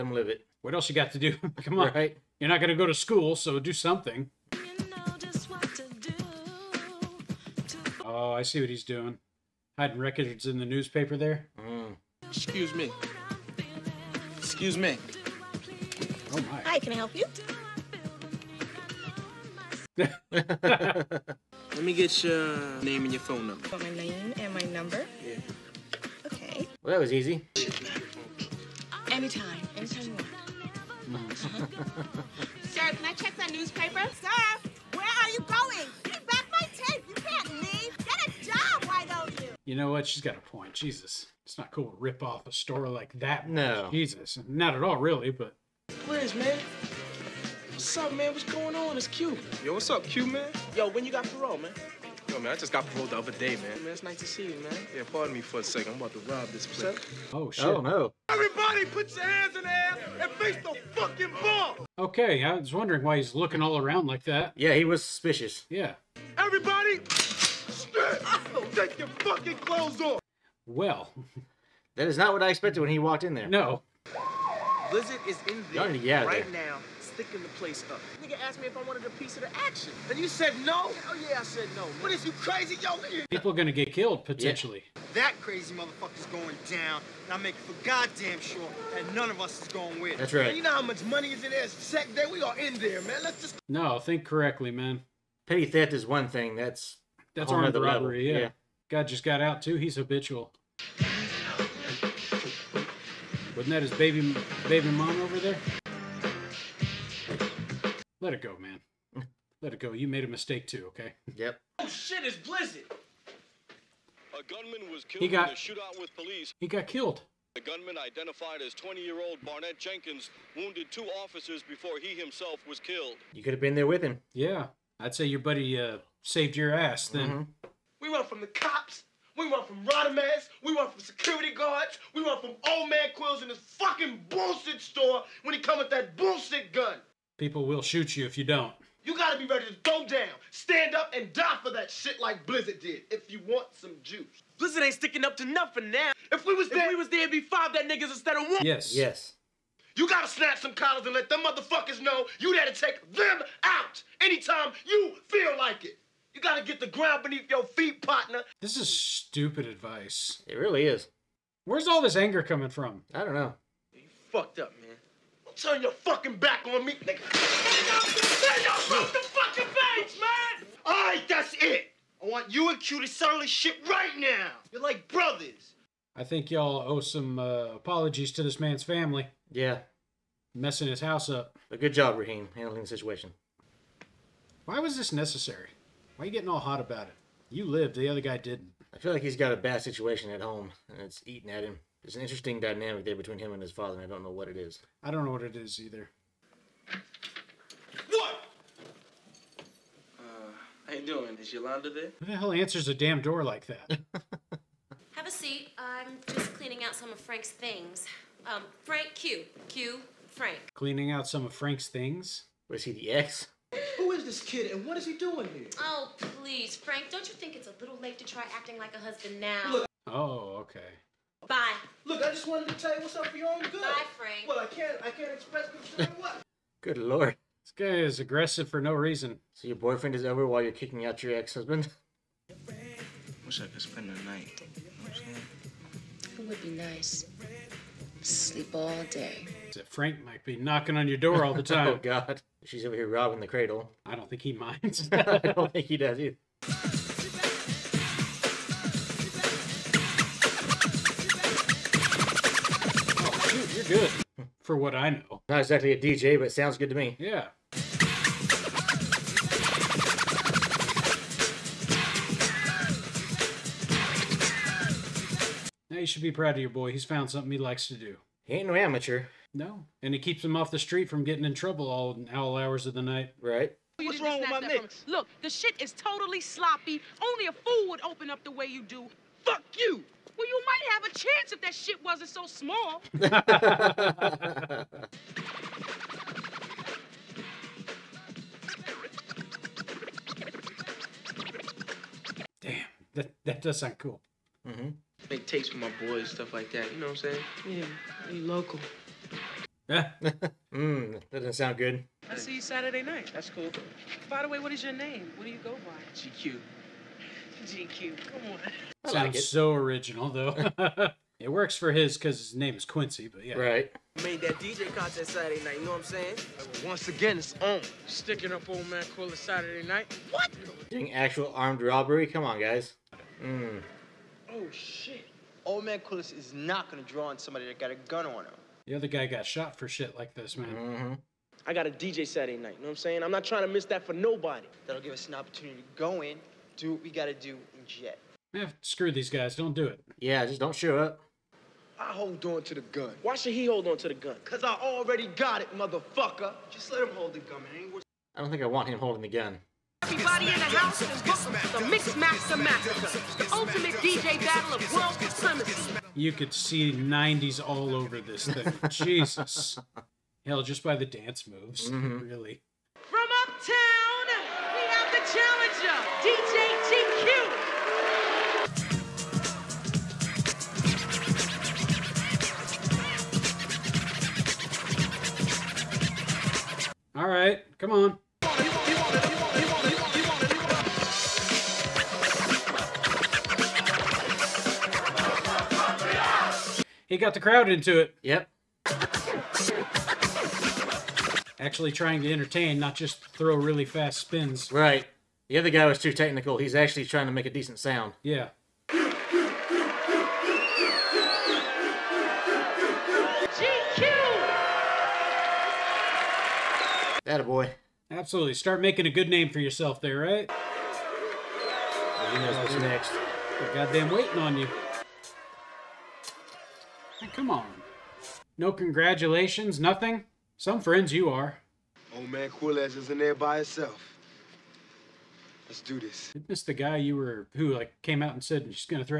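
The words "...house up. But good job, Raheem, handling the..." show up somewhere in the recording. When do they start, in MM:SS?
03:01.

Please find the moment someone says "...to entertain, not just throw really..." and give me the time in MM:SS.
06:32.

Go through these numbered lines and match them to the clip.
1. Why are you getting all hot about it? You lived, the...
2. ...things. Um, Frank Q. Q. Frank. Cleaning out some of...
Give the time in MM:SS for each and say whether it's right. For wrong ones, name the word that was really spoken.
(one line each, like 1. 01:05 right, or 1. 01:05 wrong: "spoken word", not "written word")
1. 03:06 right
2. 03:27 right.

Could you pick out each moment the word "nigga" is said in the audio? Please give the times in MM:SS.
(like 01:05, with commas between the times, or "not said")
01:18, 02:27, 02:46.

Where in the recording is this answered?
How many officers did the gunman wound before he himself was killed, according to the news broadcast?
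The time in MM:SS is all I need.
02:00.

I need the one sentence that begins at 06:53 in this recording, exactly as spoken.
They're goddamn waiting on you come on.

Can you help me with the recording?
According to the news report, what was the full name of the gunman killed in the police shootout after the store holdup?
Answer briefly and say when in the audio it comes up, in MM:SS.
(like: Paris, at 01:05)
Barnett Jenkins, at 01:59.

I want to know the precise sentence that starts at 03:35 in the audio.
Oh, please, Frank, don't you think it's a little late to try acting like a husband now?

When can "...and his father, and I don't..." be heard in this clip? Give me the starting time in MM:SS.
03:13.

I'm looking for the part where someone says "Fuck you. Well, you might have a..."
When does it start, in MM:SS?
04:39.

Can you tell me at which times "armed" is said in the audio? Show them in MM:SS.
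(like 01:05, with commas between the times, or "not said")
01:37, 05:21.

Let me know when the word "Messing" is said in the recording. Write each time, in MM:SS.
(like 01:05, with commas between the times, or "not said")
03:00.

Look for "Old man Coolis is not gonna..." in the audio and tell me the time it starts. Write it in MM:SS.
05:25.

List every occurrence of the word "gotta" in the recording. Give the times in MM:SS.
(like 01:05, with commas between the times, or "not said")
02:19, 02:30, 02:36, 05:37.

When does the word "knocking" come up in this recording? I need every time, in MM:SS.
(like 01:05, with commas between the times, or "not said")
04:00.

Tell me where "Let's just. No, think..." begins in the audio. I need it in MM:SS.
01:33.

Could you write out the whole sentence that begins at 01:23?
People are gonna get killed potentially.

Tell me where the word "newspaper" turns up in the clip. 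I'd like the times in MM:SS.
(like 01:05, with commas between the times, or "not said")
00:10, 00:33.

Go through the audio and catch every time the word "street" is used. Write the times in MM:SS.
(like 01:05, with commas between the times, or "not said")
04:30.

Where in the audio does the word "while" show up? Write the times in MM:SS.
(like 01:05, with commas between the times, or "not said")
03:50.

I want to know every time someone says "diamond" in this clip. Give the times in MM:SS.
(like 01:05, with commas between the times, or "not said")
not said.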